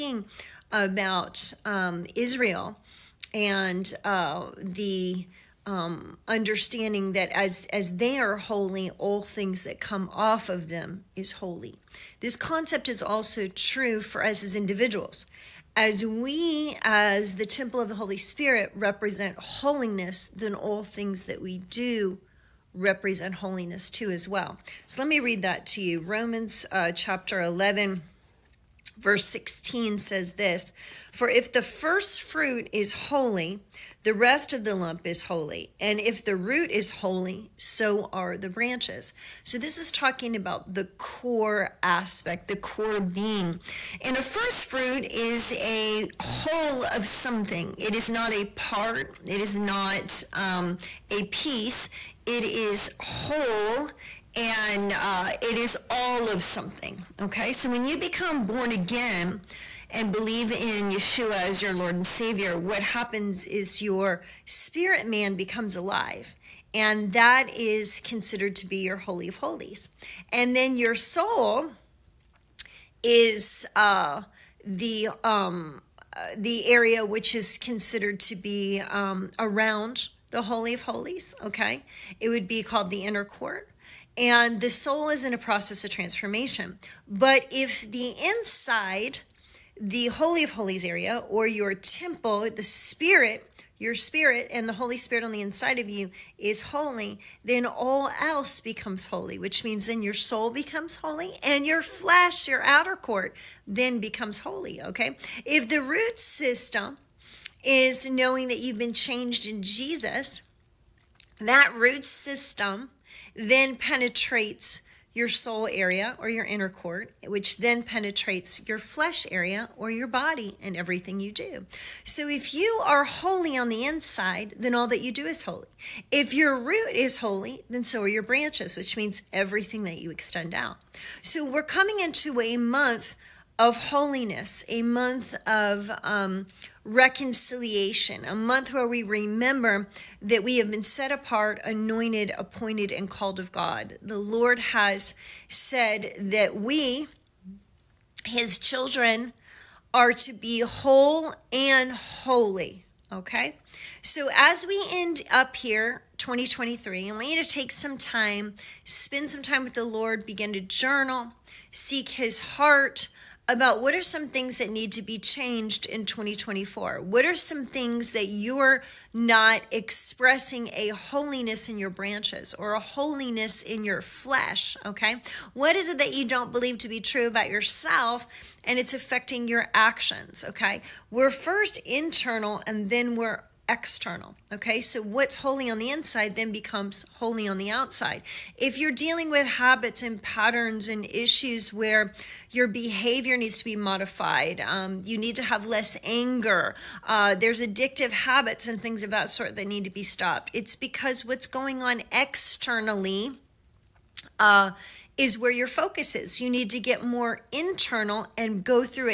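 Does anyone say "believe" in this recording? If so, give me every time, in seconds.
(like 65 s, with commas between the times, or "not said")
60 s, 176 s.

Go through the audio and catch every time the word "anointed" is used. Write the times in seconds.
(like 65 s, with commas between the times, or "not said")
141 s.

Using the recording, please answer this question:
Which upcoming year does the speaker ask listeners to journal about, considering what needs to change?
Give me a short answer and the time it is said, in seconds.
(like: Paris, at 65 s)
2024, at 166 s.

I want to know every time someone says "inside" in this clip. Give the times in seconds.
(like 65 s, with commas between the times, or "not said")
88 s, 95 s, 123 s, 185 s.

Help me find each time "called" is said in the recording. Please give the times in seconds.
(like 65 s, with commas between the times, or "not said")
82 s, 143 s.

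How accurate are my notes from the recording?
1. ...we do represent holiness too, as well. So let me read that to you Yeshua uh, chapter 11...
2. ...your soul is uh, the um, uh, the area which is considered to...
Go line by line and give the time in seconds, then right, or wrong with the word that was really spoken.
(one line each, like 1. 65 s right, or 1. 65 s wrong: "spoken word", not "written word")
1. 21 s wrong: "Romans", not "Yeshua"
2. 70 s right.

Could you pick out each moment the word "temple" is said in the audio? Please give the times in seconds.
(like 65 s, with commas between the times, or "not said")
17 s, 91 s.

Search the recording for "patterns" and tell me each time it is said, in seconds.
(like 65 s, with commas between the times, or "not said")
190 s.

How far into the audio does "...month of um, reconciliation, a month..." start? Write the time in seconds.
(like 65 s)
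134 s.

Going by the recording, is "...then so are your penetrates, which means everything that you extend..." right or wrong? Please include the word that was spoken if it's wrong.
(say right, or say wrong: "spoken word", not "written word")
wrong: "branches", not "penetrates".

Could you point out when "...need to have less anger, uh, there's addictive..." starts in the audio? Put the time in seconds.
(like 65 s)
195 s.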